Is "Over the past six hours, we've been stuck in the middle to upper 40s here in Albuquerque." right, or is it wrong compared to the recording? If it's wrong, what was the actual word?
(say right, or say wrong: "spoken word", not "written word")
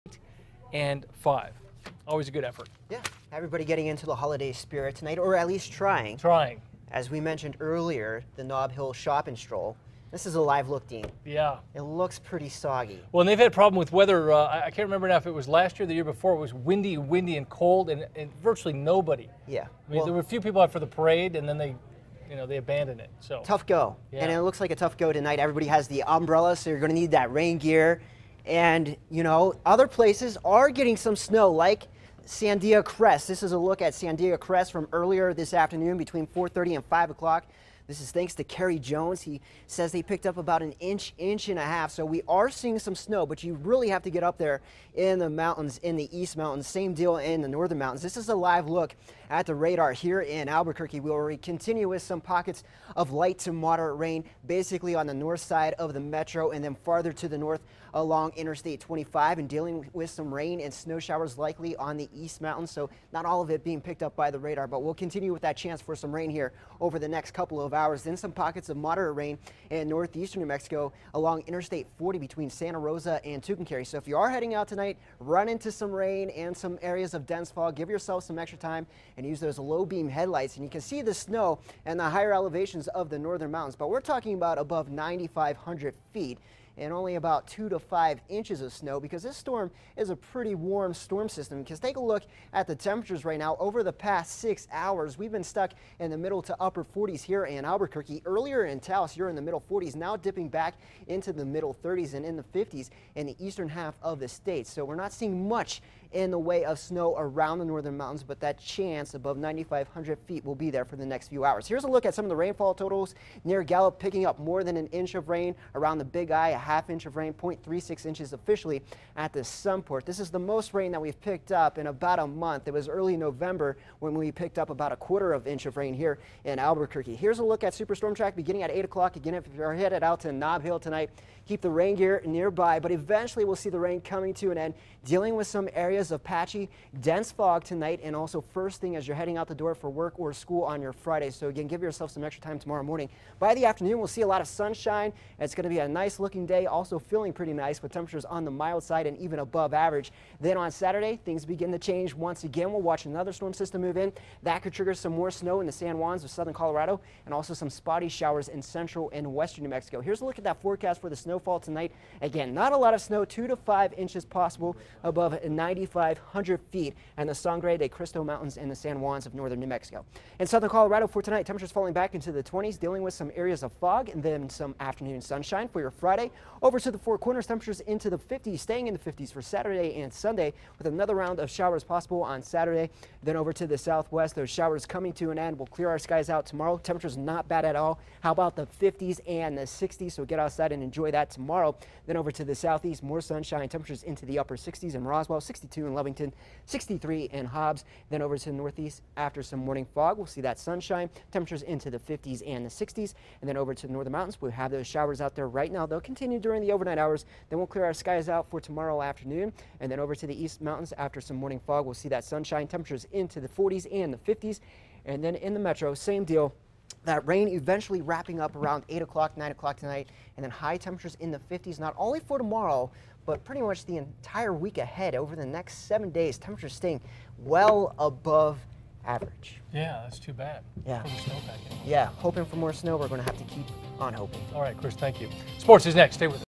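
right.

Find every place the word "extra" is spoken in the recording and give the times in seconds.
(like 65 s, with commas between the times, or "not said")
78 s, 142 s.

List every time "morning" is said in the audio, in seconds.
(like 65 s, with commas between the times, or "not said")
142 s, 199 s, 211 s.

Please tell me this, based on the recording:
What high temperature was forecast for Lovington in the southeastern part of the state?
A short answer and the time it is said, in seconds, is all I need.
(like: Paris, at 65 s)
62, at 195 s.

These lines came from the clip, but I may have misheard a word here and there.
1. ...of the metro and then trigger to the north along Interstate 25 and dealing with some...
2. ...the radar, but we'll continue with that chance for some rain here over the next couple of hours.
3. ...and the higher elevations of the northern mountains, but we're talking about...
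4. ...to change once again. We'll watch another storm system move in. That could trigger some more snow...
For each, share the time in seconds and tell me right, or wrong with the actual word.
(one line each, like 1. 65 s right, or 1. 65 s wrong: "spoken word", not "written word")
1. 55 s wrong: "farther", not "trigger"
2. 64 s right
3. 81 s right
4. 151 s right.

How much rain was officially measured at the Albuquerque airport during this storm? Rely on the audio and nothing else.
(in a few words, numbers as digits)
0.36 inches.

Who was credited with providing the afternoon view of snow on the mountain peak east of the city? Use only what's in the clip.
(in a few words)
Kerry Jones.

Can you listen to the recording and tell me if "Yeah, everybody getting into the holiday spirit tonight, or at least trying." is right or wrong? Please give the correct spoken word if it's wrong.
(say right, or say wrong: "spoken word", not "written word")
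right.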